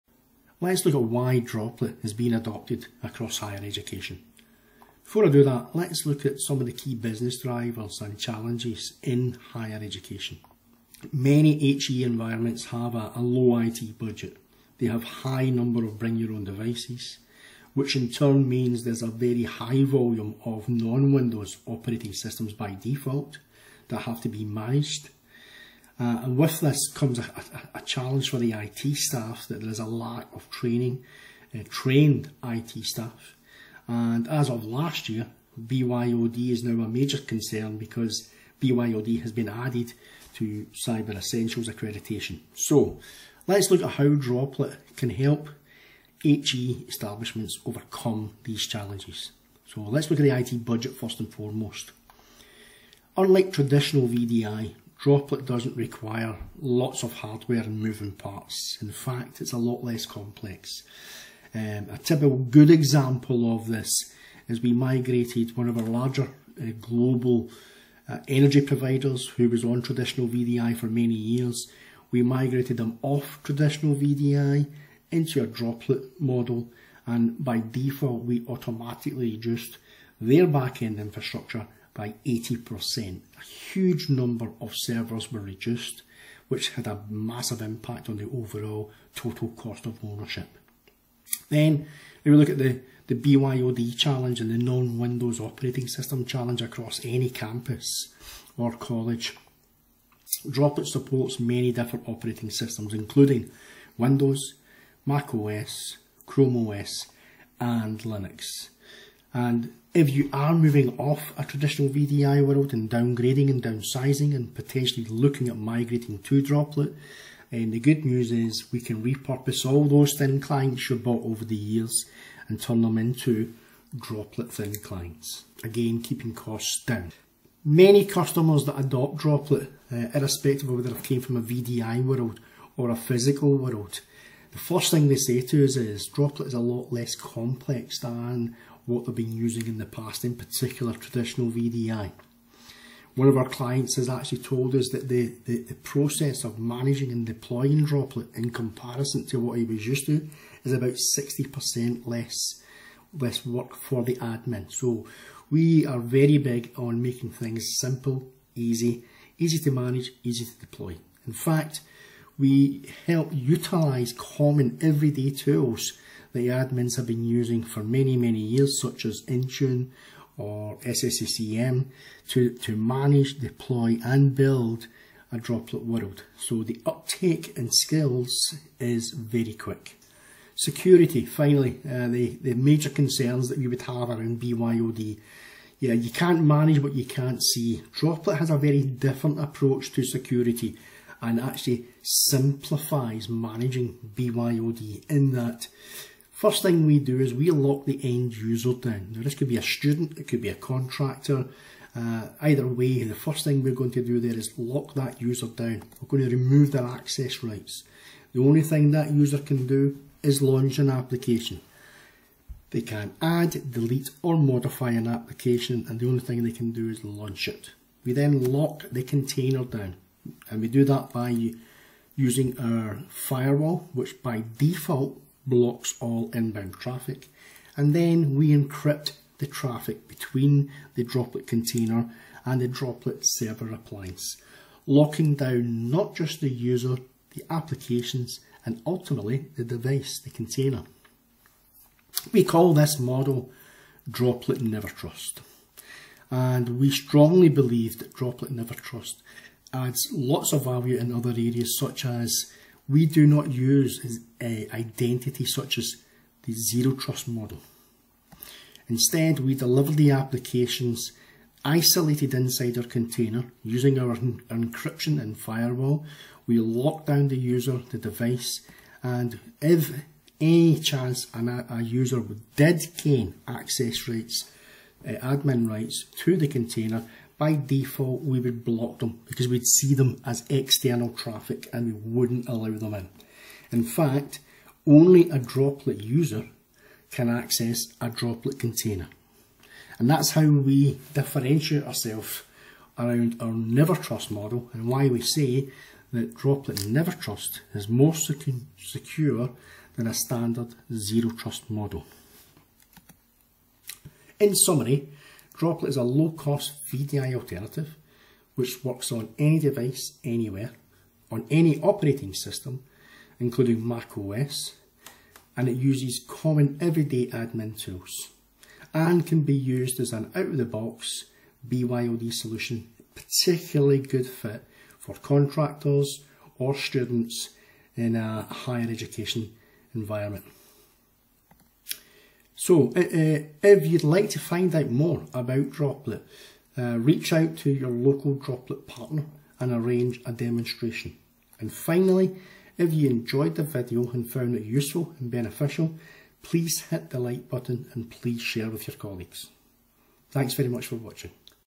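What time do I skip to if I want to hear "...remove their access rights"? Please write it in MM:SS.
03:26.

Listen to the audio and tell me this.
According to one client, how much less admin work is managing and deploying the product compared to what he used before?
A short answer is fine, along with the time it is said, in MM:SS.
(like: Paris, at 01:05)
60%, at 02:31.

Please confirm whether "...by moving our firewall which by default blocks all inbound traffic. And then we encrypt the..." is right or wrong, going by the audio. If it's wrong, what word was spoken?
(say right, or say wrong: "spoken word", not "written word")
wrong: "using", not "moving".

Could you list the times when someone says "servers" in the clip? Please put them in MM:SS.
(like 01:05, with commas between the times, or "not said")
01:24, 03:53.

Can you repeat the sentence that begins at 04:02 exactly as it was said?
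We call this model Droplet Never Trust.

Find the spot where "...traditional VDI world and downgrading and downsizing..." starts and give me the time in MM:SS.
01:51.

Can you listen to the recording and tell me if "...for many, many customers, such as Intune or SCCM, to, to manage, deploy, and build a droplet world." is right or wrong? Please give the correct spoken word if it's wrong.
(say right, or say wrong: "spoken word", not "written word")
wrong: "years", not "customers".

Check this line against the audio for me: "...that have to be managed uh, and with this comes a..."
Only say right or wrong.
right.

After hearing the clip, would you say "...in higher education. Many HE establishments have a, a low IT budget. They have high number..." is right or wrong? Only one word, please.
wrong.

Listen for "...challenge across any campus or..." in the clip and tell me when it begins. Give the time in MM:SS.
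01:36.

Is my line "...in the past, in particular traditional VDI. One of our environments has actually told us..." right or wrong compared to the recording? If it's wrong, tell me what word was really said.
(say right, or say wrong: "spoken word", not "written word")
wrong: "clients", not "environments".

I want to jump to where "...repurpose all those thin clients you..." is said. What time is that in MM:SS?
01:59.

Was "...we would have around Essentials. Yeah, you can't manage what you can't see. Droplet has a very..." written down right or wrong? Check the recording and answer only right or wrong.
wrong.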